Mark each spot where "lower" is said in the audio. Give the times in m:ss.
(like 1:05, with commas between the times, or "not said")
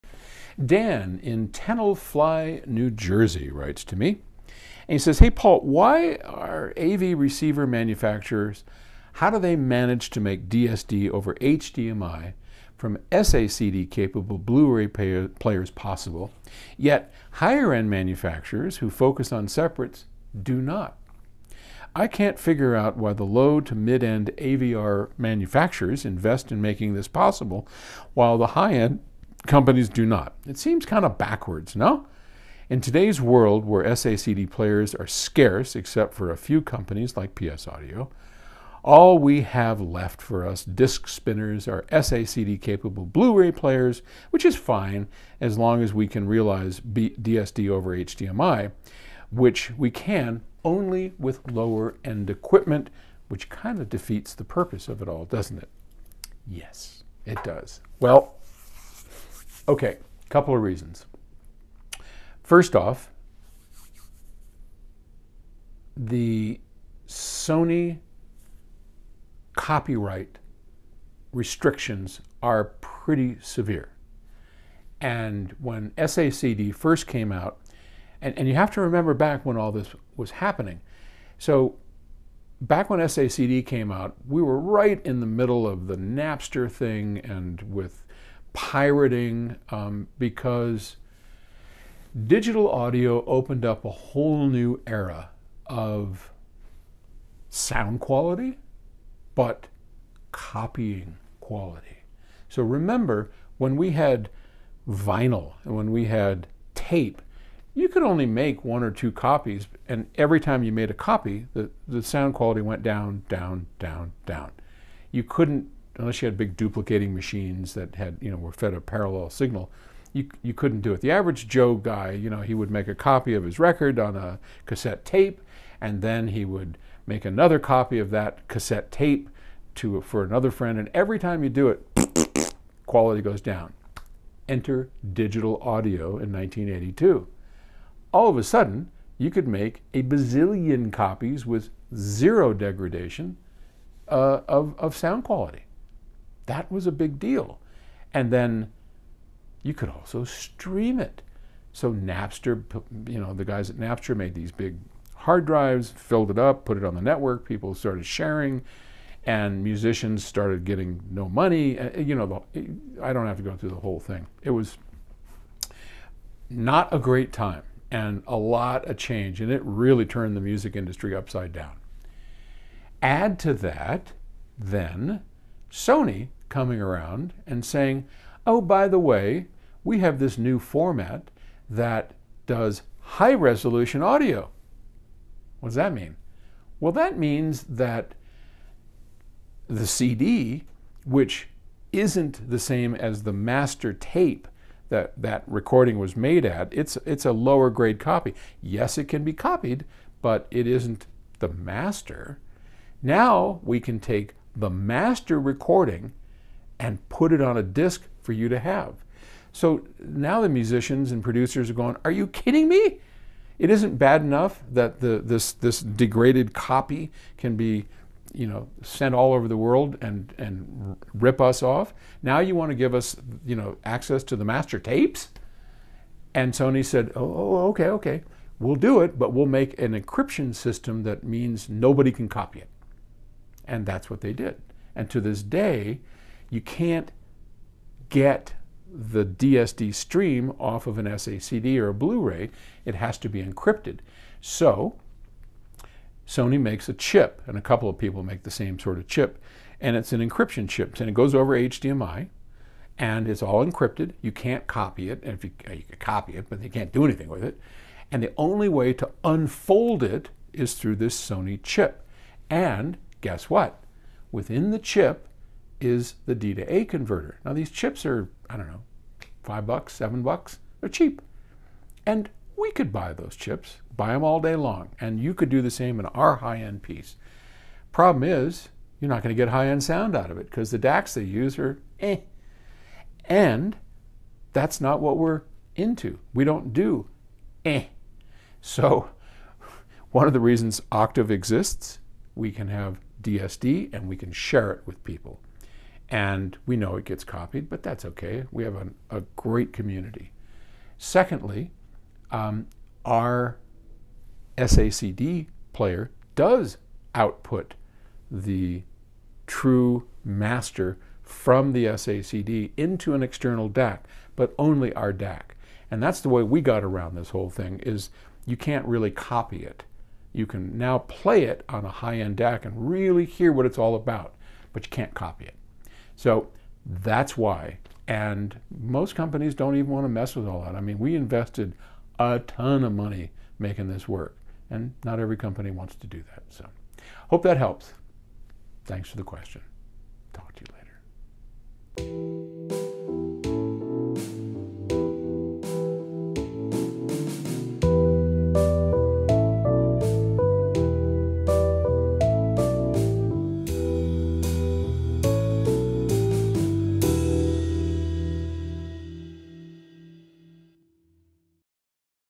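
0:51, 3:17.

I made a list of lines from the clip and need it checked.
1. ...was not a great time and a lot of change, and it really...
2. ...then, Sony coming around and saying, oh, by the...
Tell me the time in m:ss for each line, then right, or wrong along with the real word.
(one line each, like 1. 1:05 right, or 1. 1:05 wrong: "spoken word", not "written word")
1. 2:44 right
2. 2:54 right.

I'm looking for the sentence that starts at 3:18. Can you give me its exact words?
Yes, it can be copied, but it isn't the master.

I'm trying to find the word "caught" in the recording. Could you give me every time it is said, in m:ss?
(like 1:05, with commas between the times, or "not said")
not said.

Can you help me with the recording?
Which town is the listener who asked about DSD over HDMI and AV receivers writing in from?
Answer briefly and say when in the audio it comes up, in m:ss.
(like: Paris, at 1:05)
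Tenafly, New Jersey, at 0:01.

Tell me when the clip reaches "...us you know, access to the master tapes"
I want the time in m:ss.
3:42.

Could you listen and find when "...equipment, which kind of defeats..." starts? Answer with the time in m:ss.
0:52.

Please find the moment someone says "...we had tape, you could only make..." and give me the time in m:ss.
1:45.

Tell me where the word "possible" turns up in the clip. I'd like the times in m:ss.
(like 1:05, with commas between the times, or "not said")
0:15, 0:27.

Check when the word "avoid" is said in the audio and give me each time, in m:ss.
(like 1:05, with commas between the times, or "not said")
not said.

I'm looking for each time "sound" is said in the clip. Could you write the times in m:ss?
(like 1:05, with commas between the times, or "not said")
1:37, 1:52, 2:24, 4:39.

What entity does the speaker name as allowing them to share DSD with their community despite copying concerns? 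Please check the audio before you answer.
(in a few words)
Octave.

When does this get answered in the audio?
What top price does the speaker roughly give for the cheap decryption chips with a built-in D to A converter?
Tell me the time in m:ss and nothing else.
4:29.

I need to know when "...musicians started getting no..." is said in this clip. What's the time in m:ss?
2:39.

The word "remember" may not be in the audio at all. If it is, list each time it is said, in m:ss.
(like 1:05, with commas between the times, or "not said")
1:18, 1:42.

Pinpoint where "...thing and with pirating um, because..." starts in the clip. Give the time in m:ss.
1:26.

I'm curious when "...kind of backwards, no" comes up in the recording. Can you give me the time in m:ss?
0:30.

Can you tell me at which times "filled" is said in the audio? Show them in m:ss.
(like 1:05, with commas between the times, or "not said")
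2:35.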